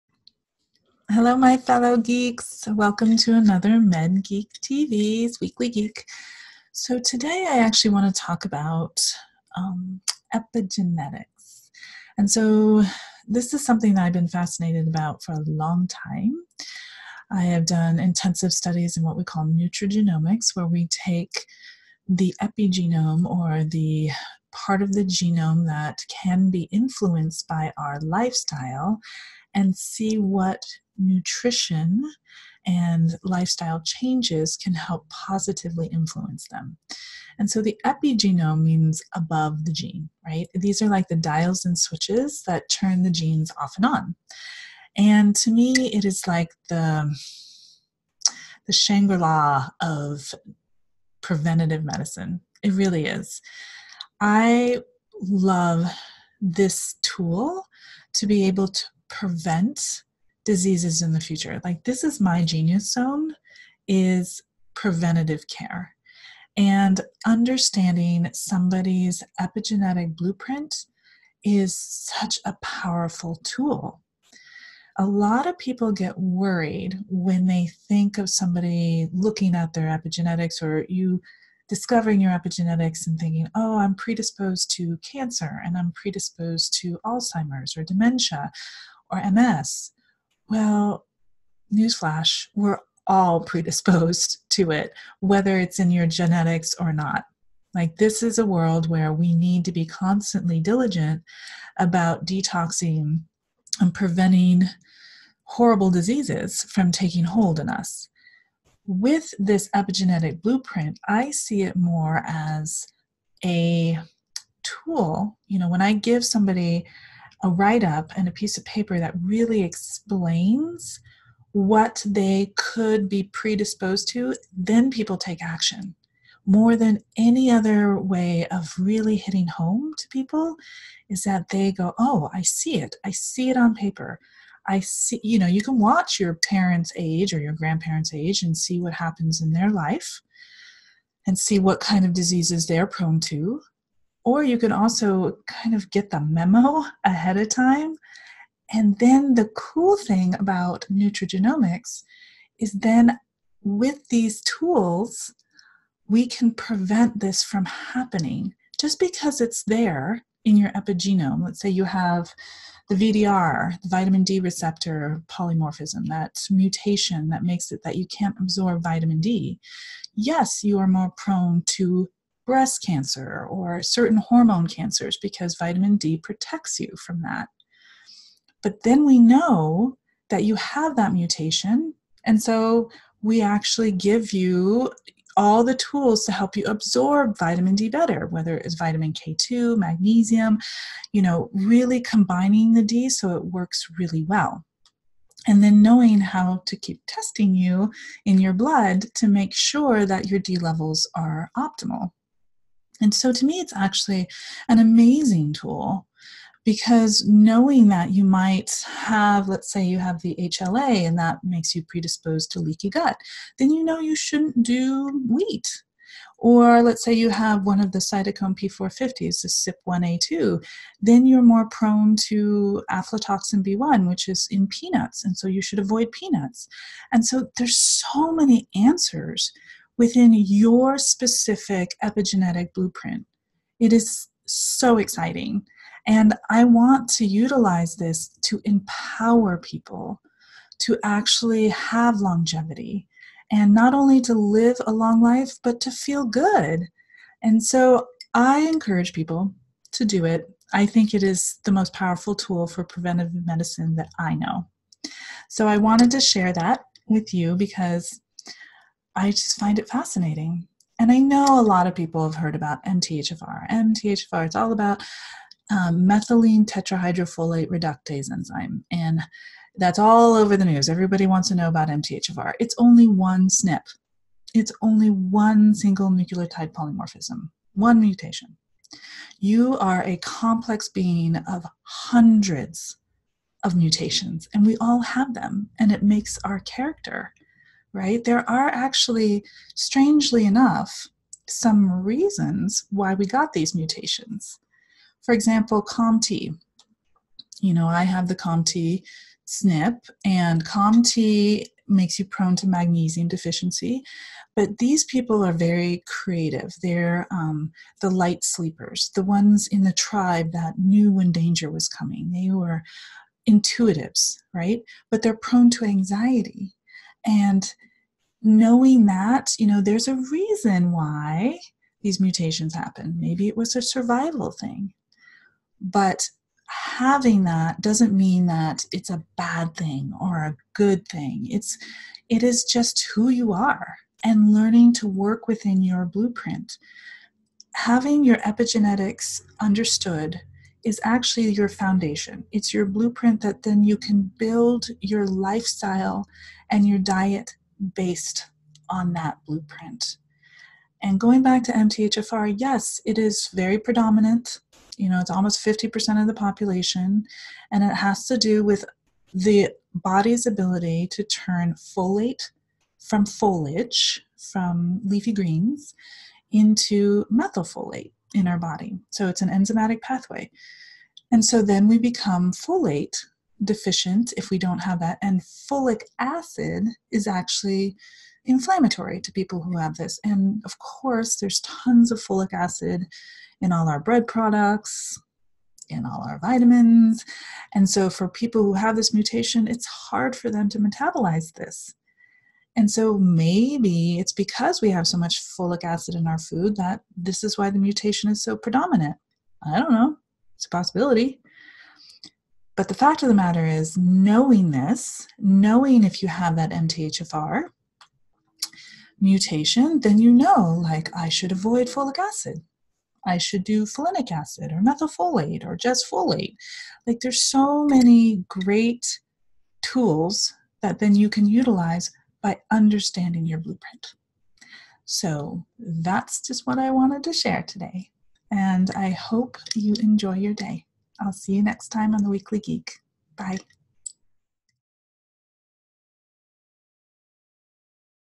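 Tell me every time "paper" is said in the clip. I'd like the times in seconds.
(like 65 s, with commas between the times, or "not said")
118 s, 133 s.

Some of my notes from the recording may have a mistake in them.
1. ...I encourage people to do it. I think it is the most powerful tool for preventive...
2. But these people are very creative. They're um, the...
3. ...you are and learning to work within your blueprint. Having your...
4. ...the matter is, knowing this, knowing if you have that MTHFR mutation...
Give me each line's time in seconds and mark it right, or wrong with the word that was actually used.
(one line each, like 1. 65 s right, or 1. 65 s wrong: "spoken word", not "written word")
1. 248 s right
2. 304 s right
3. 333 s right
4. 403 s right.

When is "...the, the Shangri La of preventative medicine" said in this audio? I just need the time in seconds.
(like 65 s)
46 s.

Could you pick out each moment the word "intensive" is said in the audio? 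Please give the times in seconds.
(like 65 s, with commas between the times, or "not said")
17 s.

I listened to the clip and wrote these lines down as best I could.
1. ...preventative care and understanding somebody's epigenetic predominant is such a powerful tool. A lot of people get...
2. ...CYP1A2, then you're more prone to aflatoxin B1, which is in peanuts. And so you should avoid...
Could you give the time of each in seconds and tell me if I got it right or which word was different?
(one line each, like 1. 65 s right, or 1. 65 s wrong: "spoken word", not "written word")
1. 64 s wrong: "blueprint", not "predominant"
2. 219 s right.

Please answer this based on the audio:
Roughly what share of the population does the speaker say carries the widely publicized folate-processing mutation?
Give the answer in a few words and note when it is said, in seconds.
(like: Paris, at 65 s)
50%, at 355 s.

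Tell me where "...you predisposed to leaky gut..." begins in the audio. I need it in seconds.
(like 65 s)
211 s.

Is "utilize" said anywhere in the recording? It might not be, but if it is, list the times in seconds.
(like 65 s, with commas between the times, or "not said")
237 s, 421 s.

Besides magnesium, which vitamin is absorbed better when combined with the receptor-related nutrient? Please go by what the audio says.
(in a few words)
vitamin K2.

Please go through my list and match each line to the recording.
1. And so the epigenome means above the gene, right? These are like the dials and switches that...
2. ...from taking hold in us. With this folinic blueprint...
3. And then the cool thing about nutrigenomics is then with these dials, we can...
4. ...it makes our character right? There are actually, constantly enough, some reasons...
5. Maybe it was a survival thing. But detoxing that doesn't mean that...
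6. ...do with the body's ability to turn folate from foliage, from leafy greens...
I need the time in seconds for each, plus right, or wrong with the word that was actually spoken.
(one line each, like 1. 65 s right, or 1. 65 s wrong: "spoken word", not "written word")
1. 37 s right
2. 106 s wrong: "epigenetic", not "folinic"
3. 148 s wrong: "tools", not "dials"
4. 285 s wrong: "strangely", not "constantly"
5. 323 s wrong: "having", not "detoxing"
6. 358 s right.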